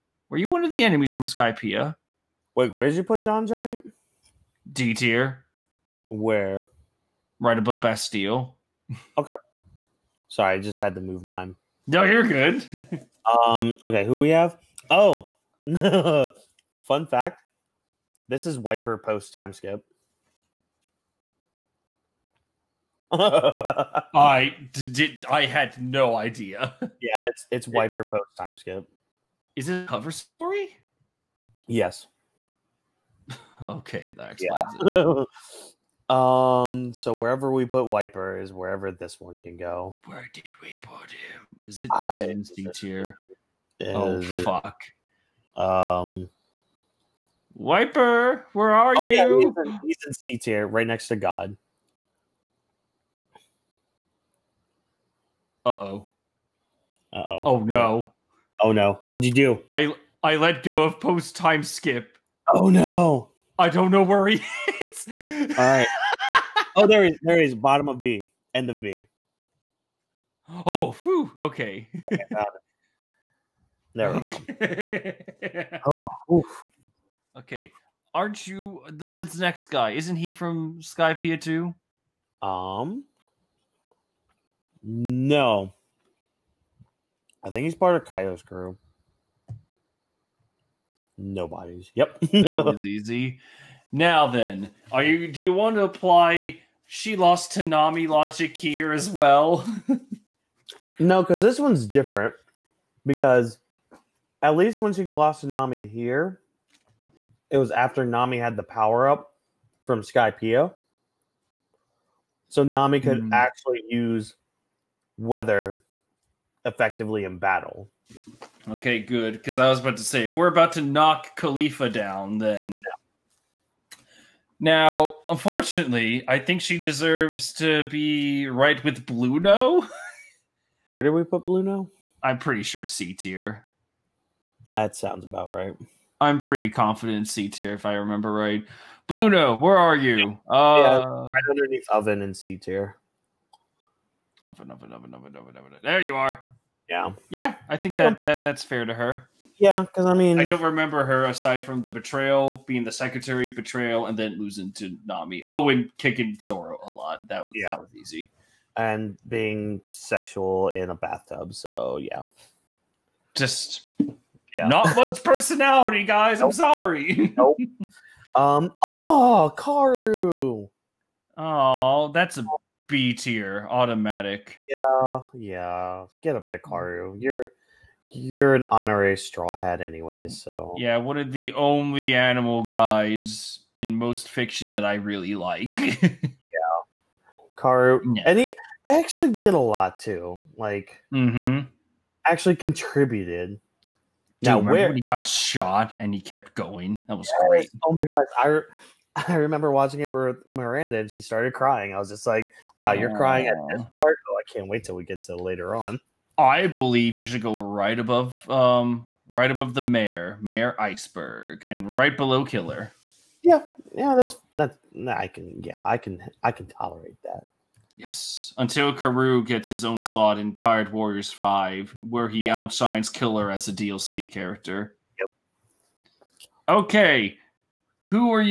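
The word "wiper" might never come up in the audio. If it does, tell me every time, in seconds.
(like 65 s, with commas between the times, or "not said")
18 s, 27 s, 37 s, 47 s.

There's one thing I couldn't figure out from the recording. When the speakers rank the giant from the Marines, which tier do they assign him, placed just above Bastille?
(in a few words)
D tier.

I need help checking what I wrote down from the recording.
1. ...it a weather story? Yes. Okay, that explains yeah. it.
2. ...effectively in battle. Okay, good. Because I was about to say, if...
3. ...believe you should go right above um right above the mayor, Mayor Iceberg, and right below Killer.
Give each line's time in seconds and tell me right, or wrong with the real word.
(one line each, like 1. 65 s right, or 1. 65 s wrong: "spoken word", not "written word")
1. 29 s wrong: "cover", not "weather"
2. 116 s right
3. 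206 s right.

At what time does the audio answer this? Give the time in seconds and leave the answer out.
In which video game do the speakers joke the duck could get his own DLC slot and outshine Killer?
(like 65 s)
220 s.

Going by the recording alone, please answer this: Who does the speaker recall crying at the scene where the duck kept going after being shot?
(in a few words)
Miranda.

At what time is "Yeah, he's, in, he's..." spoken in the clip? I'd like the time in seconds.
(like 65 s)
49 s.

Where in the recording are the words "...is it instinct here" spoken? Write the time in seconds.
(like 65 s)
42 s.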